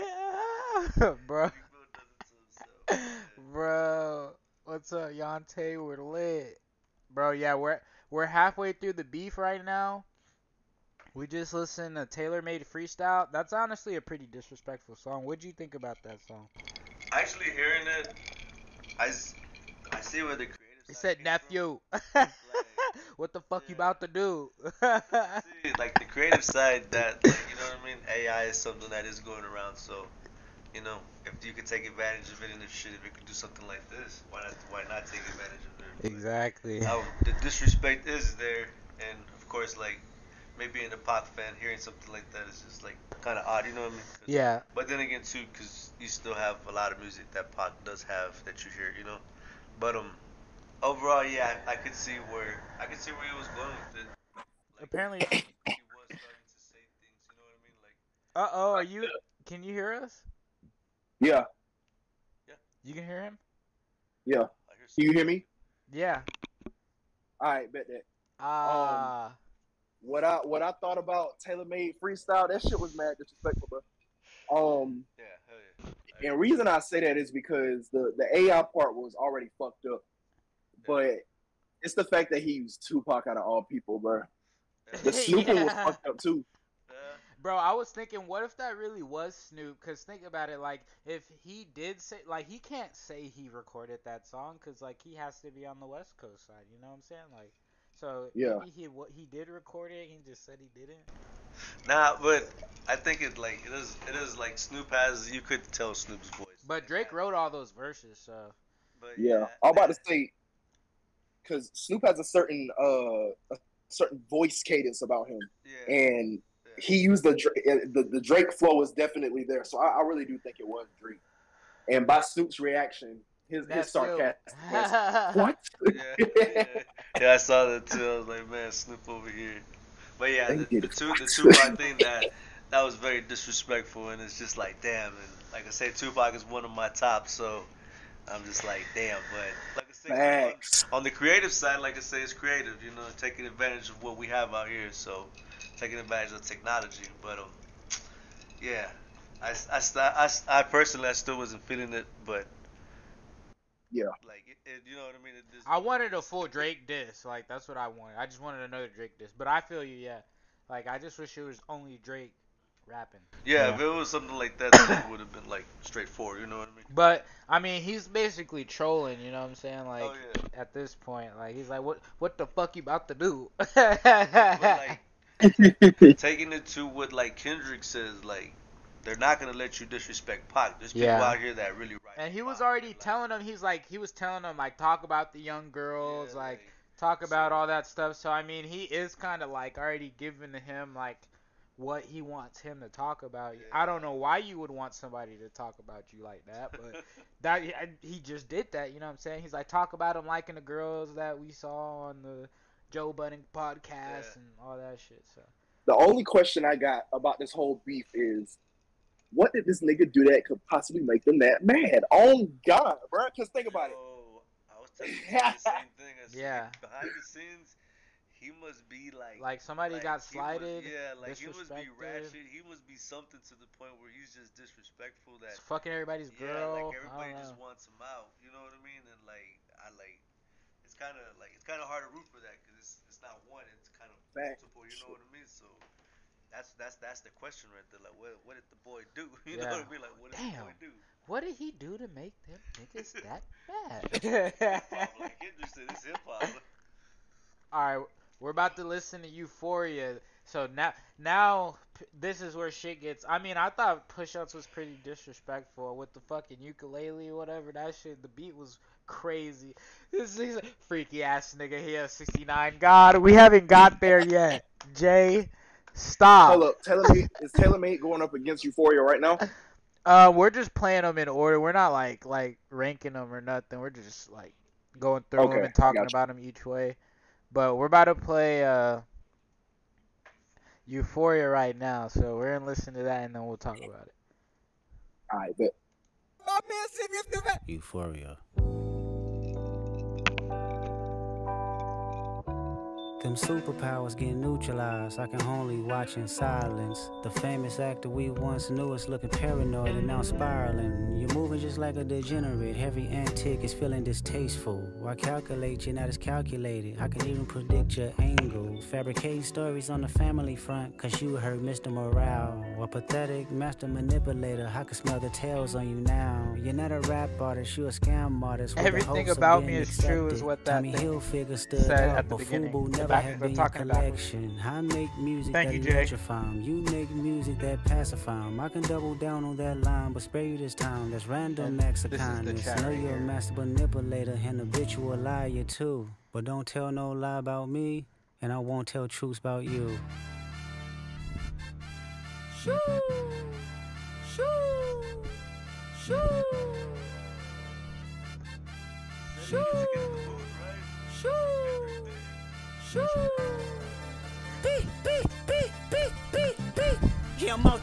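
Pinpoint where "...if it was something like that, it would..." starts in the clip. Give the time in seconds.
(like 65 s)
163 s.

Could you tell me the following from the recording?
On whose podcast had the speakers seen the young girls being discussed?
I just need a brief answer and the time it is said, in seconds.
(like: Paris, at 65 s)
Joe Budden, at 202 s.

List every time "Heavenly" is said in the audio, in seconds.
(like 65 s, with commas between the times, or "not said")
not said.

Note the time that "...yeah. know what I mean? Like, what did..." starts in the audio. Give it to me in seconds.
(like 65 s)
239 s.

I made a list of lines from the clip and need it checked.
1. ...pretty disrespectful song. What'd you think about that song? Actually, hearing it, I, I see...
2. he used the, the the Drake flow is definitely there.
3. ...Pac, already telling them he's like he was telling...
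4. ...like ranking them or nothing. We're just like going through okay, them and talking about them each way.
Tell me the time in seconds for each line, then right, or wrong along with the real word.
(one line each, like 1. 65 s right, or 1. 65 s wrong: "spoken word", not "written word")
1. 14 s right
2. 116 s right
3. 182 s right
4. 272 s right.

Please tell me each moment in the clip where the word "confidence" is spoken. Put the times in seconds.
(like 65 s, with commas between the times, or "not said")
not said.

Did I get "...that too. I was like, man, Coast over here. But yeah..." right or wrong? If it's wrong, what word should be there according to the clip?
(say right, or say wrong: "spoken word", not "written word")
wrong: "Snoop", not "Coast".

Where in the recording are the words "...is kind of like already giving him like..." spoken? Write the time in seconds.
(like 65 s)
188 s.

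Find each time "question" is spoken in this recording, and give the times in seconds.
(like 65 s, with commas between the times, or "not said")
206 s, 237 s.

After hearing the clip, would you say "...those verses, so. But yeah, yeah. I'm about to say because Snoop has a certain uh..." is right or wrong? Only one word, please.
right.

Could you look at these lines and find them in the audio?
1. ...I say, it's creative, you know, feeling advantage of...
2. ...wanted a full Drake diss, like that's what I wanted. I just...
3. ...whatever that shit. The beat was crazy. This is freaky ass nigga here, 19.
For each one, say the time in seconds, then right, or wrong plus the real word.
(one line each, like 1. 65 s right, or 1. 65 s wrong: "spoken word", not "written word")
1. 141 s wrong: "taking", not "feeling"
2. 155 s right
3. 257 s wrong: "69", not "19".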